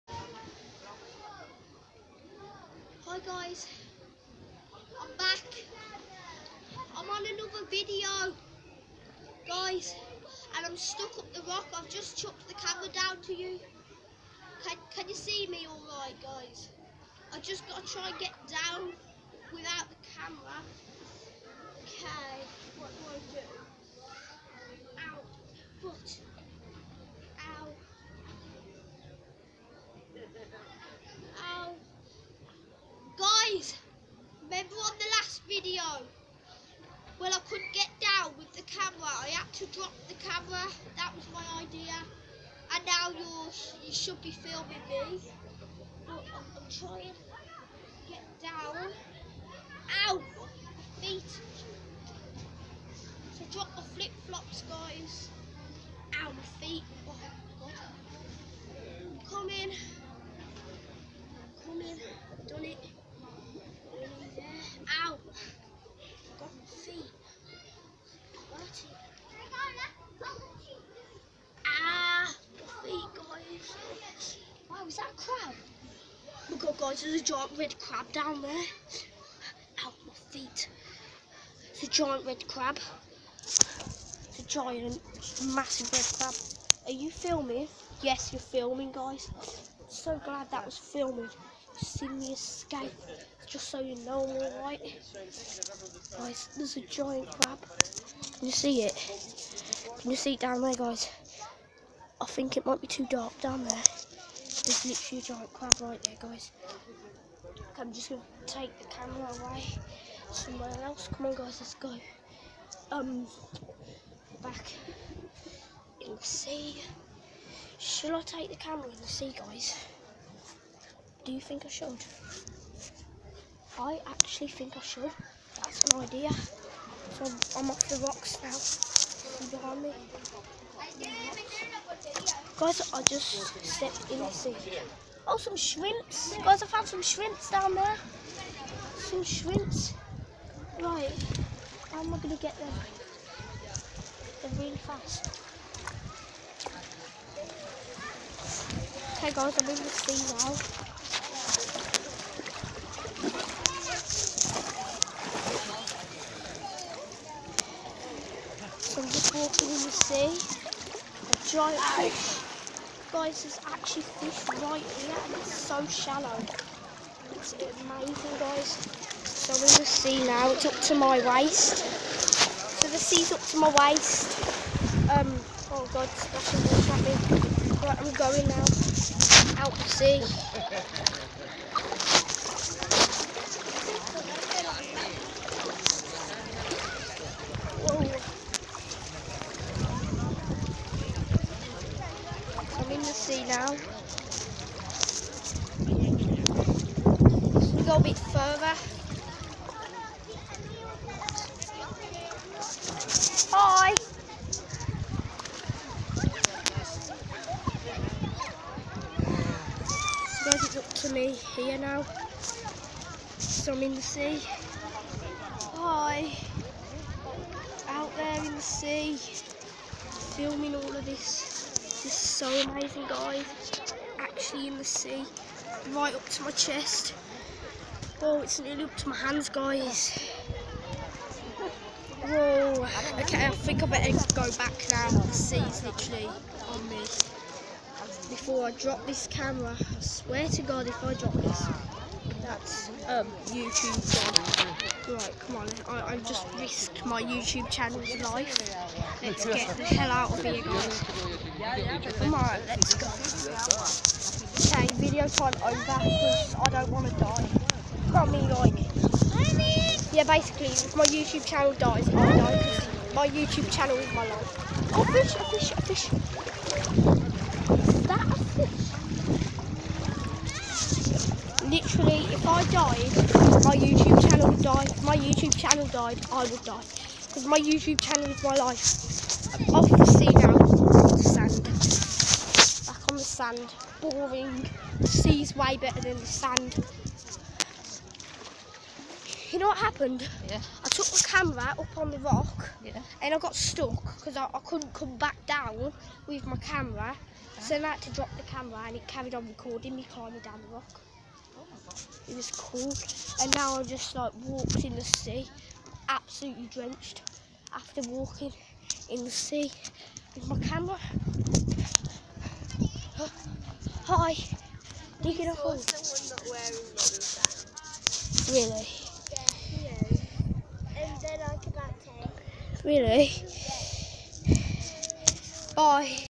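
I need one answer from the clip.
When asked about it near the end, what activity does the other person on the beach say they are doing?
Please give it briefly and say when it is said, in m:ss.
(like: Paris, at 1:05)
Digging a hole, at 5:15.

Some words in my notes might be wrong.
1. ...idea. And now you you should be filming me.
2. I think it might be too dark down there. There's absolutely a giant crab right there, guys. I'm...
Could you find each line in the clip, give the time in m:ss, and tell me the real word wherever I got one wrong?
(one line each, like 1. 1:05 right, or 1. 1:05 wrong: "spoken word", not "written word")
1. 0:41 right
2. 1:42 wrong: "literally", not "absolutely".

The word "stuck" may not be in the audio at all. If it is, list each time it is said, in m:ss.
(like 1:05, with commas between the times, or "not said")
0:10, 4:53.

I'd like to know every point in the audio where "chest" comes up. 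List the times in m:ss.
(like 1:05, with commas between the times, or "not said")
3:46.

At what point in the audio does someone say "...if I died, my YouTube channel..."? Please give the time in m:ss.
4:32.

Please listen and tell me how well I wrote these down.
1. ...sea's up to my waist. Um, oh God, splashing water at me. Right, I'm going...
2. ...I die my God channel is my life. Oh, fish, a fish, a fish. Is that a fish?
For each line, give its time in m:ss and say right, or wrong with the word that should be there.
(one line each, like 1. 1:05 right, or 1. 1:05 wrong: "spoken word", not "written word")
1. 2:52 right
2. 4:22 wrong: "YouTube", not "God".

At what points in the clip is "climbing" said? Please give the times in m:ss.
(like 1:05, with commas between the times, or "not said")
5:00.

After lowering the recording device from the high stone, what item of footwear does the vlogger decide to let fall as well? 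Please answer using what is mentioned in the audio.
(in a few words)
flip flops.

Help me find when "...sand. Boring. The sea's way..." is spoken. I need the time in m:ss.
4:43.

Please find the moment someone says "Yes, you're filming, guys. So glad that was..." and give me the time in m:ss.
1:28.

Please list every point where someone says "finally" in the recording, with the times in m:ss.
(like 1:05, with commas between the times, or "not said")
not said.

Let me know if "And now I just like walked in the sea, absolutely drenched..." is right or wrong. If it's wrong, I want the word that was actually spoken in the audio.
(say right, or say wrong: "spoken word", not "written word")
right.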